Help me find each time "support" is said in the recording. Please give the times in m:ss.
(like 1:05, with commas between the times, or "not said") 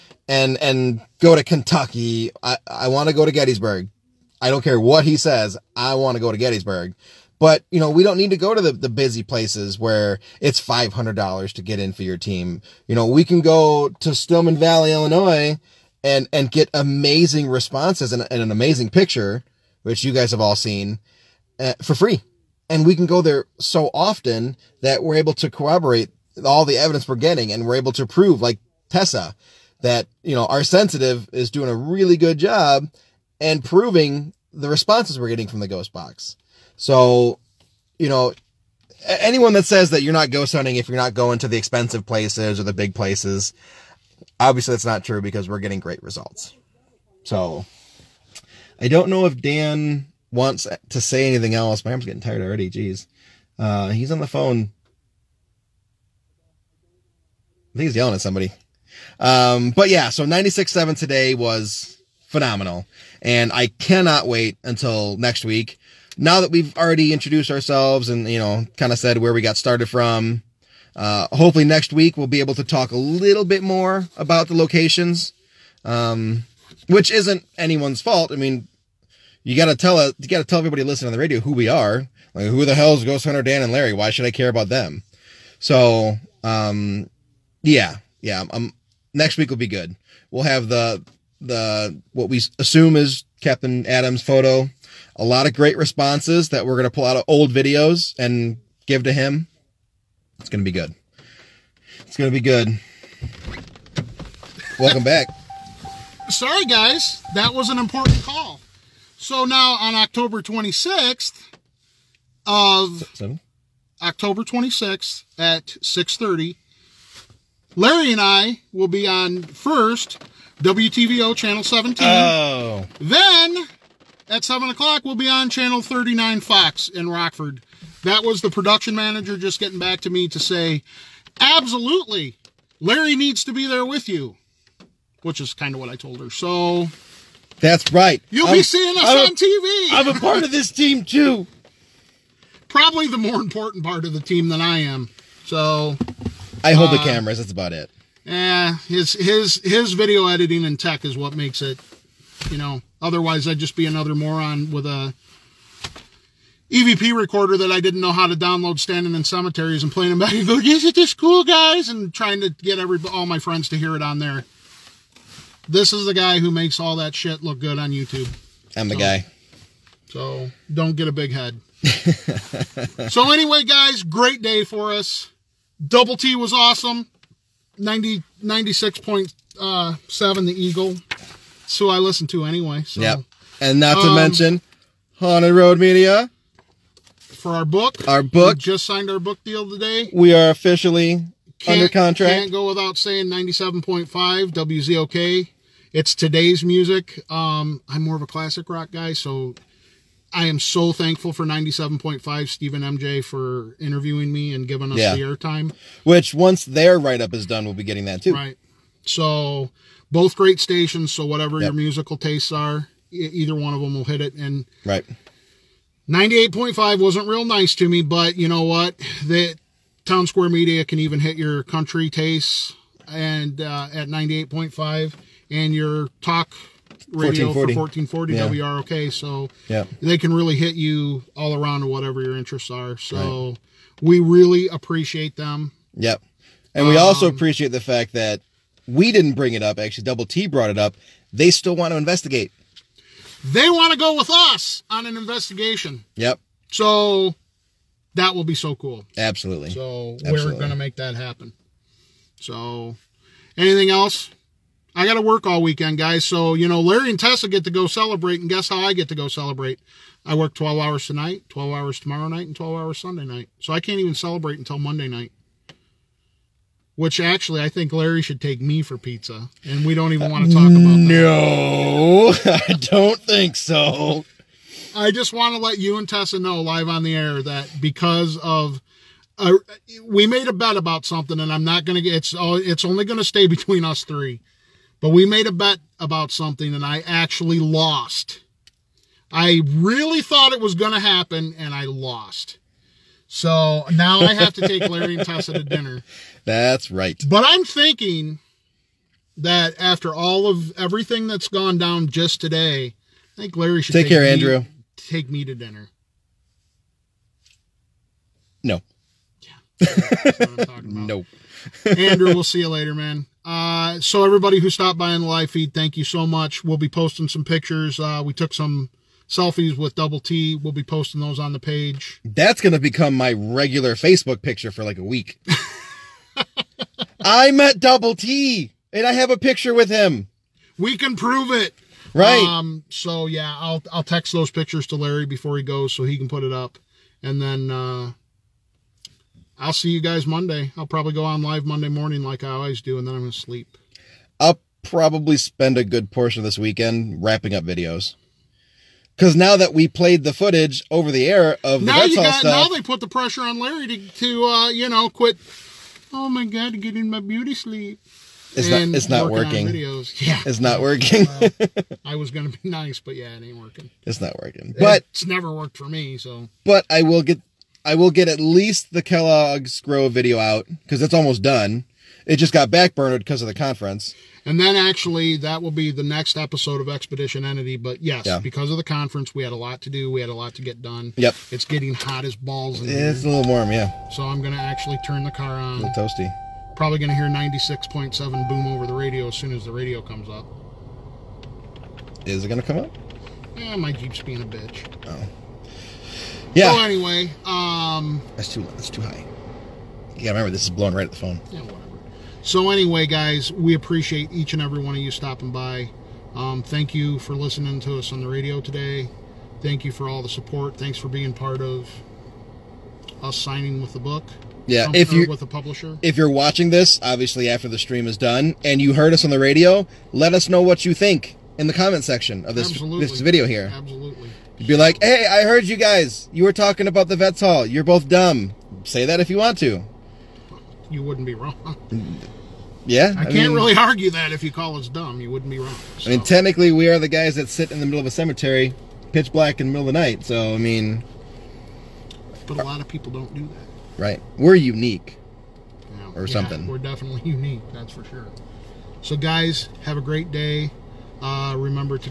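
6:50.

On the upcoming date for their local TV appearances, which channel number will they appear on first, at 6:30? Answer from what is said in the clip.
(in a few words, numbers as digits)
17.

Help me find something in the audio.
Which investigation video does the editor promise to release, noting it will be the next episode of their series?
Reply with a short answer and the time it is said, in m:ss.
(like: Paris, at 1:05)
Kellogg's Grove, at 6:09.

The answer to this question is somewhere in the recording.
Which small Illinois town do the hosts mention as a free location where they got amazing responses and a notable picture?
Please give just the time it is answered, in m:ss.
0:14.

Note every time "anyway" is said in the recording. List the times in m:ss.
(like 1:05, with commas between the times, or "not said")
2:53, 3:02, 6:36, 6:42.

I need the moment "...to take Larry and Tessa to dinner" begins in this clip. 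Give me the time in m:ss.
4:54.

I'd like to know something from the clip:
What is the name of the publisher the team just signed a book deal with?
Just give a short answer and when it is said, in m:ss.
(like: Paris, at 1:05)
Haunted Road Media, at 3:05.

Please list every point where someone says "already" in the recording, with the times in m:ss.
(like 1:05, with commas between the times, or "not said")
0:52, 1:06.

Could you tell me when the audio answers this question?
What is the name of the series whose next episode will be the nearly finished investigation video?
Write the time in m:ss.
6:16.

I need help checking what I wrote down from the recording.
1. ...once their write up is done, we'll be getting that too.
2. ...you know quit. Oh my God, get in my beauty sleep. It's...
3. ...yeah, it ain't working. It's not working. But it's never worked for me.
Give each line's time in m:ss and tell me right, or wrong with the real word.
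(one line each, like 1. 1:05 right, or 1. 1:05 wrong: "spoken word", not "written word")
1. 3:26 right
2. 5:54 right
3. 6:03 right.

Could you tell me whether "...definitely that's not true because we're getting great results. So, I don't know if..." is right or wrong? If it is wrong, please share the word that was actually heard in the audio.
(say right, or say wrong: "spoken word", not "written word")
wrong: "obviously", not "definitely".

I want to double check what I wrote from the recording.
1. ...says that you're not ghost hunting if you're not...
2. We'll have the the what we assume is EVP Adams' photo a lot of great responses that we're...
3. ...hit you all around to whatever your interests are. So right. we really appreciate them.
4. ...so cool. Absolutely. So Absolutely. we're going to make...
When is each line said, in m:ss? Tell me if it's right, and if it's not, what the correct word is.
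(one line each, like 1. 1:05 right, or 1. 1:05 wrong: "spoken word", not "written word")
1. 0:39 right
2. 1:30 wrong: "Captain", not "EVP"
3. 3:50 right
4. 4:08 right.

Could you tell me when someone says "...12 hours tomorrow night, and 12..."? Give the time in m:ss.
4:21.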